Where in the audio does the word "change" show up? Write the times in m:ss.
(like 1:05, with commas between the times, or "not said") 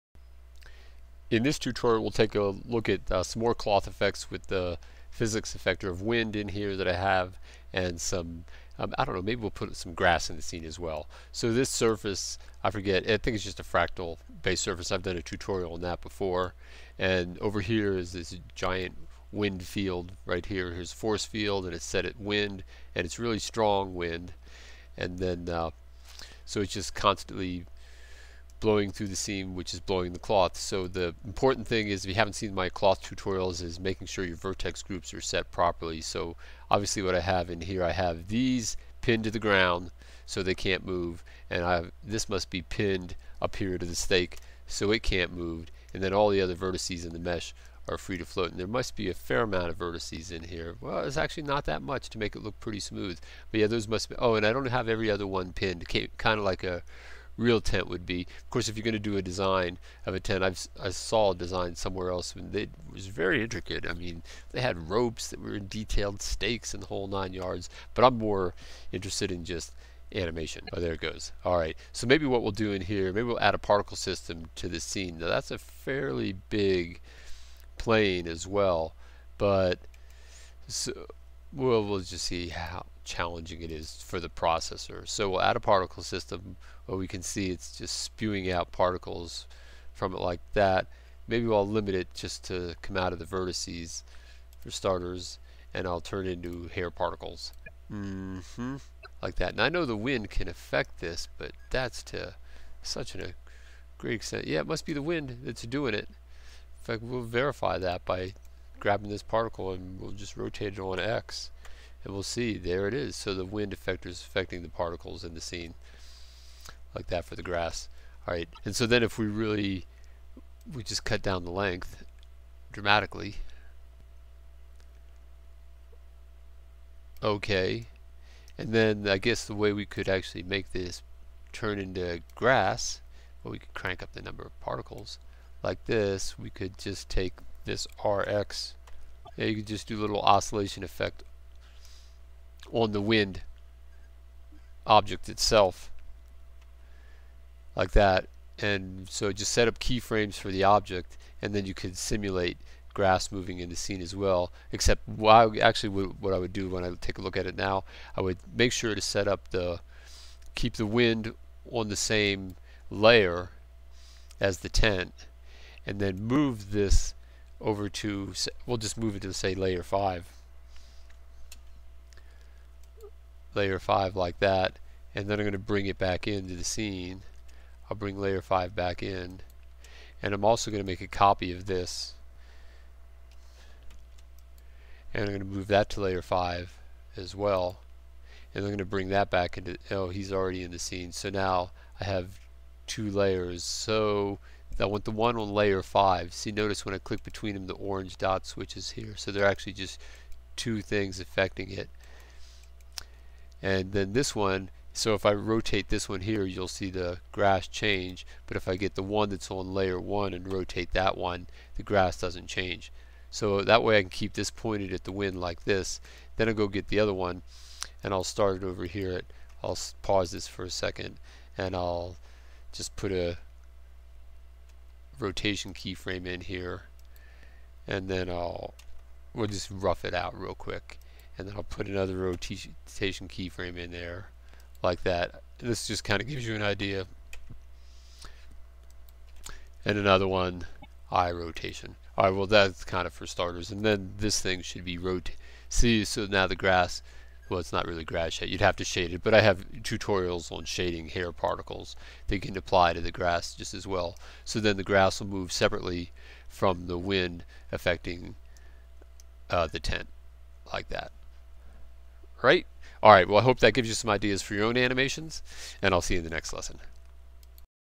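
3:27, 3:32.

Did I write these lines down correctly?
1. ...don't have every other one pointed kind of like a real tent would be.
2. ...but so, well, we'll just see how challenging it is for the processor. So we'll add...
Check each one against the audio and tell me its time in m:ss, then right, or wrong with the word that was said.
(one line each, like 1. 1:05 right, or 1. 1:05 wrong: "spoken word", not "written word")
1. 0:54 wrong: "pinned", not "pointed"
2. 1:19 right.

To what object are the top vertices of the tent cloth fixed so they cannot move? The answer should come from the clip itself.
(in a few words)
The stake.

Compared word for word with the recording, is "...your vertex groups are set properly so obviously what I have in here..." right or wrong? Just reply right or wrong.
right.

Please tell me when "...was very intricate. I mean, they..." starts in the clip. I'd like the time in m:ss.
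1:02.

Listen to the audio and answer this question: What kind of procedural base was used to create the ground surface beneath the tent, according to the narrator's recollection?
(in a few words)
Fractal.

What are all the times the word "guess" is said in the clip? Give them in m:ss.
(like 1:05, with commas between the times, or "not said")
2:09.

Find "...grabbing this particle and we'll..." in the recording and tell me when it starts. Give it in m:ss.
1:48.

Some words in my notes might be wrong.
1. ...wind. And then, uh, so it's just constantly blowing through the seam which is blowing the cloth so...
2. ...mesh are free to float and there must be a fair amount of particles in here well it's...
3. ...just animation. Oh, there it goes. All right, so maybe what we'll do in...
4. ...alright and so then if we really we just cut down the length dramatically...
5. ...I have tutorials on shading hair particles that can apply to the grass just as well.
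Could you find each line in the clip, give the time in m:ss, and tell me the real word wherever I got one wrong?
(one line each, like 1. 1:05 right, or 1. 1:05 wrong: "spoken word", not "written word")
1. 0:23 right
2. 0:47 wrong: "vertices", not "particles"
3. 1:09 right
4. 1:58 right
5. 4:09 right.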